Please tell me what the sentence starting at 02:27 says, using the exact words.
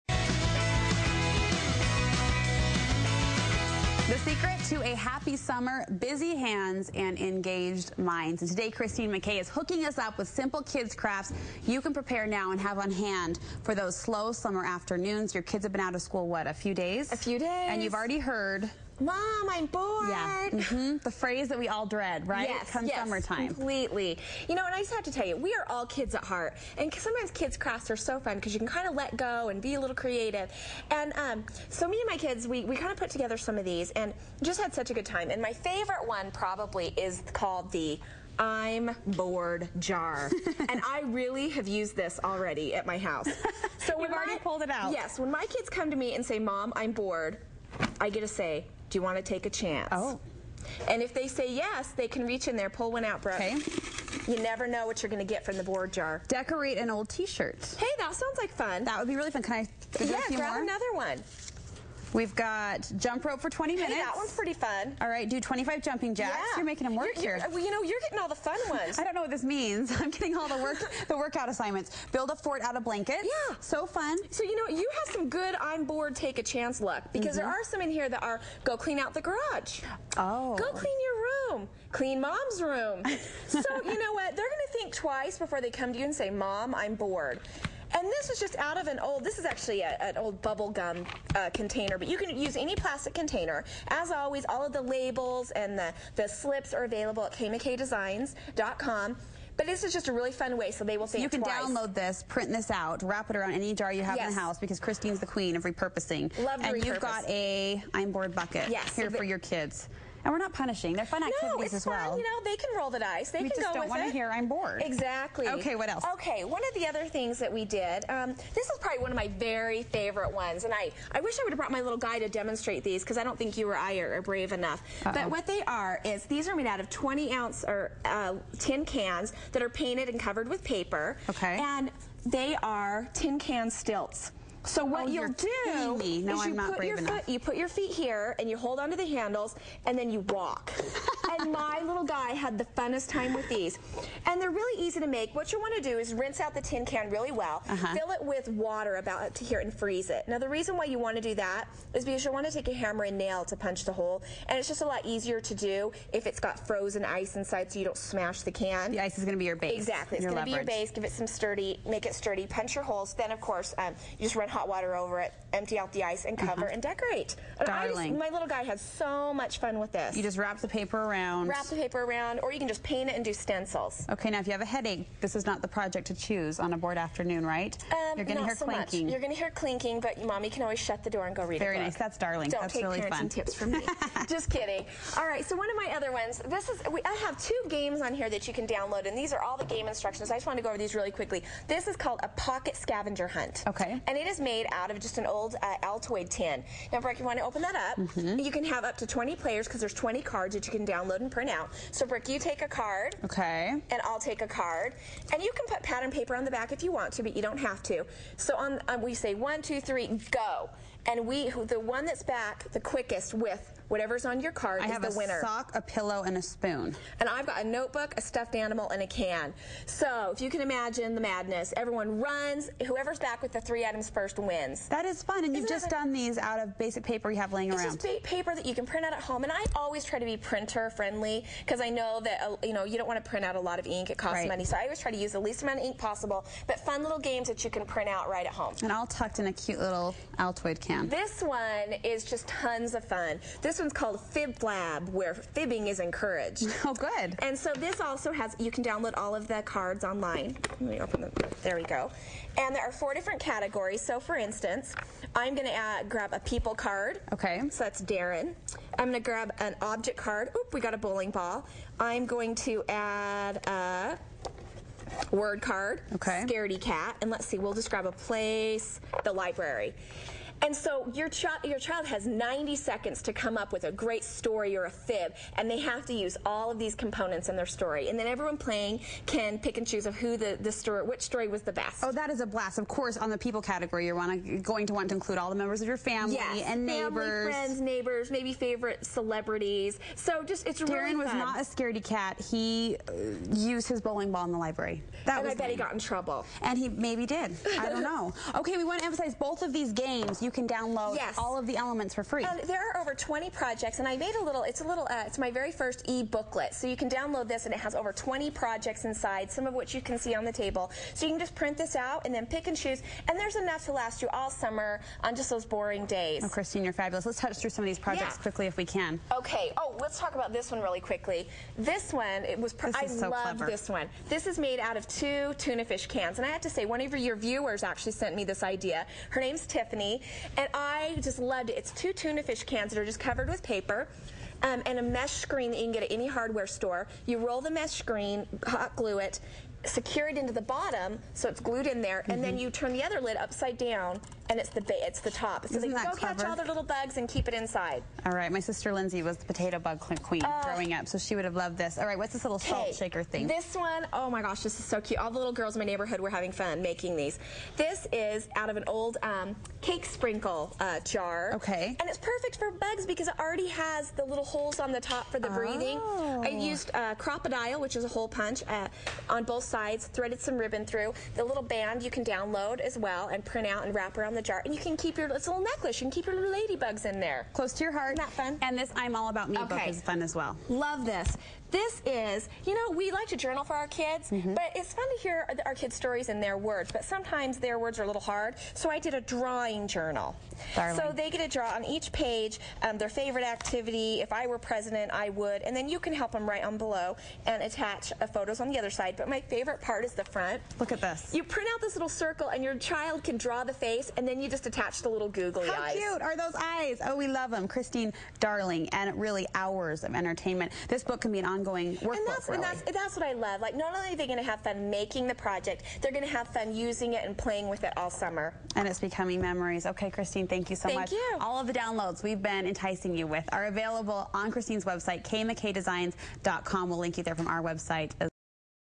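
fill it with water about to here and freeze it.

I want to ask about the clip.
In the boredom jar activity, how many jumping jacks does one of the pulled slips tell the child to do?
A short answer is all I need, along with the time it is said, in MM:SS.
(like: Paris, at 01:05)
25, at 01:05.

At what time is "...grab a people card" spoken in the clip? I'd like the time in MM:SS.
04:16.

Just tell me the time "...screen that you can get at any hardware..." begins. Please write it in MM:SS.
05:35.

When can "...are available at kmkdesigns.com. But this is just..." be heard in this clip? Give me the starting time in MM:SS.
01:36.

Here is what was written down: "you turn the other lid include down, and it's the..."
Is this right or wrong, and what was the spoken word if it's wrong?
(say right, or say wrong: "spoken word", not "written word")
wrong: "upside", not "include".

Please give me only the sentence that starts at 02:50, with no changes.
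You just wrap the paper around around.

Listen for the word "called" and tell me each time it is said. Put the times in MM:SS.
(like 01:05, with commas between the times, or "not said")
00:37, 03:11, 04:03.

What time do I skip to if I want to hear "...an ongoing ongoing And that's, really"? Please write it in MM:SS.
06:51.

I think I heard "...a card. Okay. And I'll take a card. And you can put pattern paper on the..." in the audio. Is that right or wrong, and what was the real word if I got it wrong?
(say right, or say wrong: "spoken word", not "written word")
right.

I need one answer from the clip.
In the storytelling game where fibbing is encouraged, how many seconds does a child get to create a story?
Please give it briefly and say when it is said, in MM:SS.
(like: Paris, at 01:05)
90, at 04:32.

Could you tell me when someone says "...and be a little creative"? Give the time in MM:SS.
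00:29.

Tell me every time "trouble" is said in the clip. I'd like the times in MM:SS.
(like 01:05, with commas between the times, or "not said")
04:55.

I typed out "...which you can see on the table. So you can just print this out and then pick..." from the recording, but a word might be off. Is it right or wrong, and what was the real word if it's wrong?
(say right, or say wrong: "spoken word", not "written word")
right.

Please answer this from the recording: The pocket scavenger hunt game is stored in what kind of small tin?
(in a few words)
Altoid tin.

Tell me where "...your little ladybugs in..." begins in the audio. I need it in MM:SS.
06:16.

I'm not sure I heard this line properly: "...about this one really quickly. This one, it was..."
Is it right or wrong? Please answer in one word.
right.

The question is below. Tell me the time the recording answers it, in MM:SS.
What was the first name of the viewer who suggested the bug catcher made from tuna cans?
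05:29.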